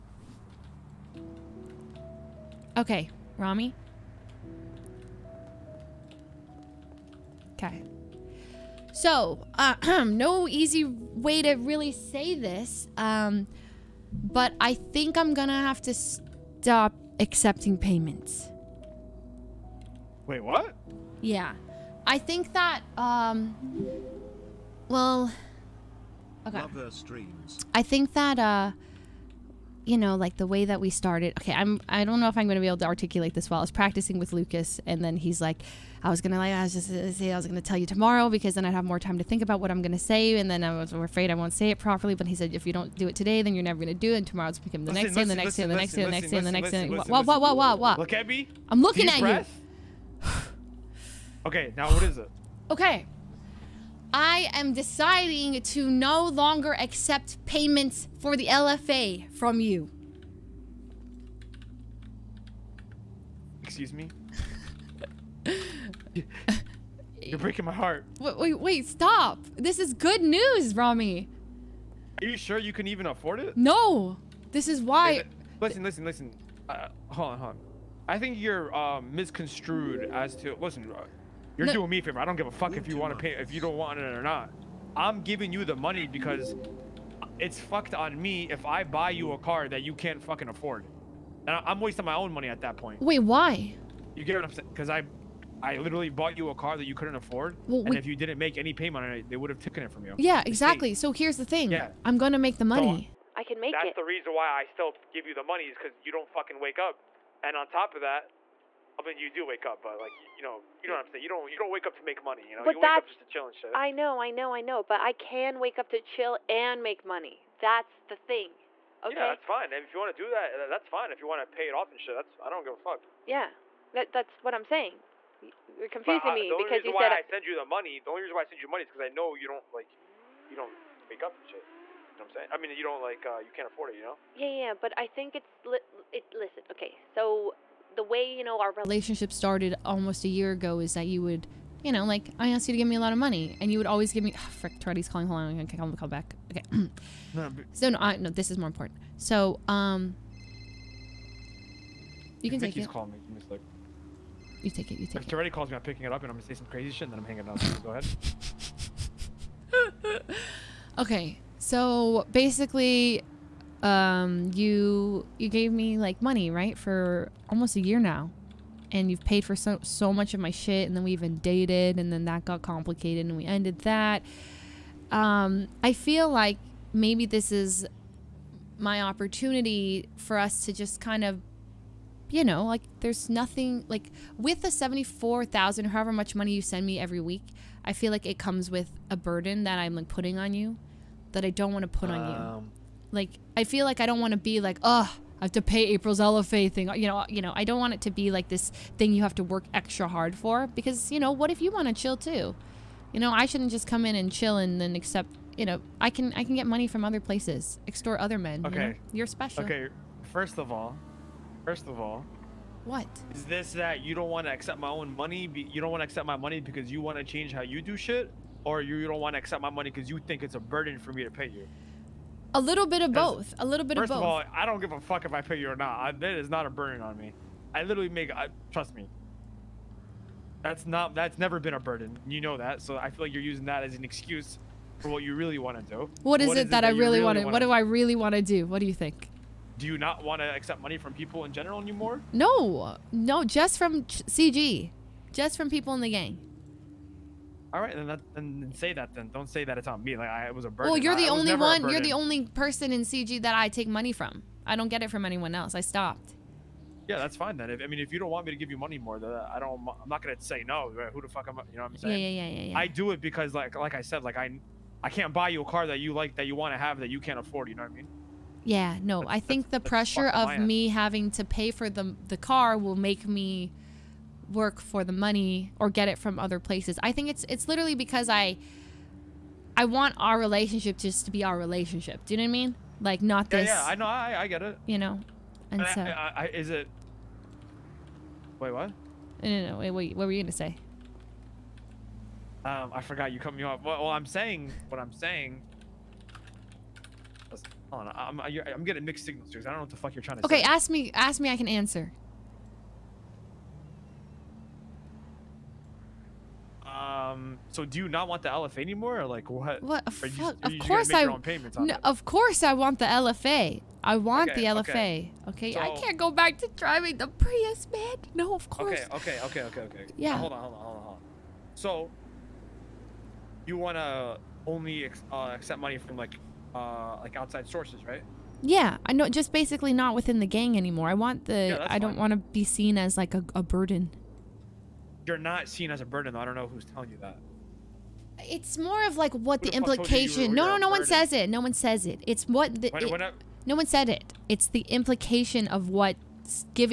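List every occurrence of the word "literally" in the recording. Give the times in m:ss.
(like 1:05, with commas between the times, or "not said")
1:35, 3:47, 4:37.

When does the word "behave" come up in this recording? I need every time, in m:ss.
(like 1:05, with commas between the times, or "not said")
not said.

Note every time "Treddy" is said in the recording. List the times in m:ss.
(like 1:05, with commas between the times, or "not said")
2:24, 2:35.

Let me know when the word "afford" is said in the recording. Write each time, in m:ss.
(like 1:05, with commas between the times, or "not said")
1:13, 1:30, 1:37, 2:13, 4:27.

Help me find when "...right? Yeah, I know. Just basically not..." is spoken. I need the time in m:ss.
5:28.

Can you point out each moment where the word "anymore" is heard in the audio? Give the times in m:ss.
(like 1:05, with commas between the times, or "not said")
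4:01, 5:08, 5:30.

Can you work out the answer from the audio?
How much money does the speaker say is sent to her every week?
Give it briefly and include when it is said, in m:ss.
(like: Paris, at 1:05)
74,000, at 3:04.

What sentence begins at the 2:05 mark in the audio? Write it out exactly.
You're confusing but, uh, me because you said I send you the money.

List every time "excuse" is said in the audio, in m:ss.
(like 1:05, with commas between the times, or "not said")
1:03, 3:54.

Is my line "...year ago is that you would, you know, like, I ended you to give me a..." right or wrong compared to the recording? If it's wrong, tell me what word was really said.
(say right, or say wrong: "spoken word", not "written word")
wrong: "asked", not "ended".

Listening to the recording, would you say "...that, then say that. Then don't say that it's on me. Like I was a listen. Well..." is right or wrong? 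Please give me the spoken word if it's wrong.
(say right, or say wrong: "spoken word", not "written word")
wrong: "burden", not "listen".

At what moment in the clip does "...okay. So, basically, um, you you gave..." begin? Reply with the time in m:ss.
2:40.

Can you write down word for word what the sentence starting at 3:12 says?
Um, like I feel like I don't want to be like, oh, I have to pay April's LFA thing.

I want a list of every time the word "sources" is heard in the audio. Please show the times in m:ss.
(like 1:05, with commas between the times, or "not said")
5:27.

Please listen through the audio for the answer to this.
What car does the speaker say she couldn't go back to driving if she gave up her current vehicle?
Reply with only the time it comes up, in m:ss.
5:17.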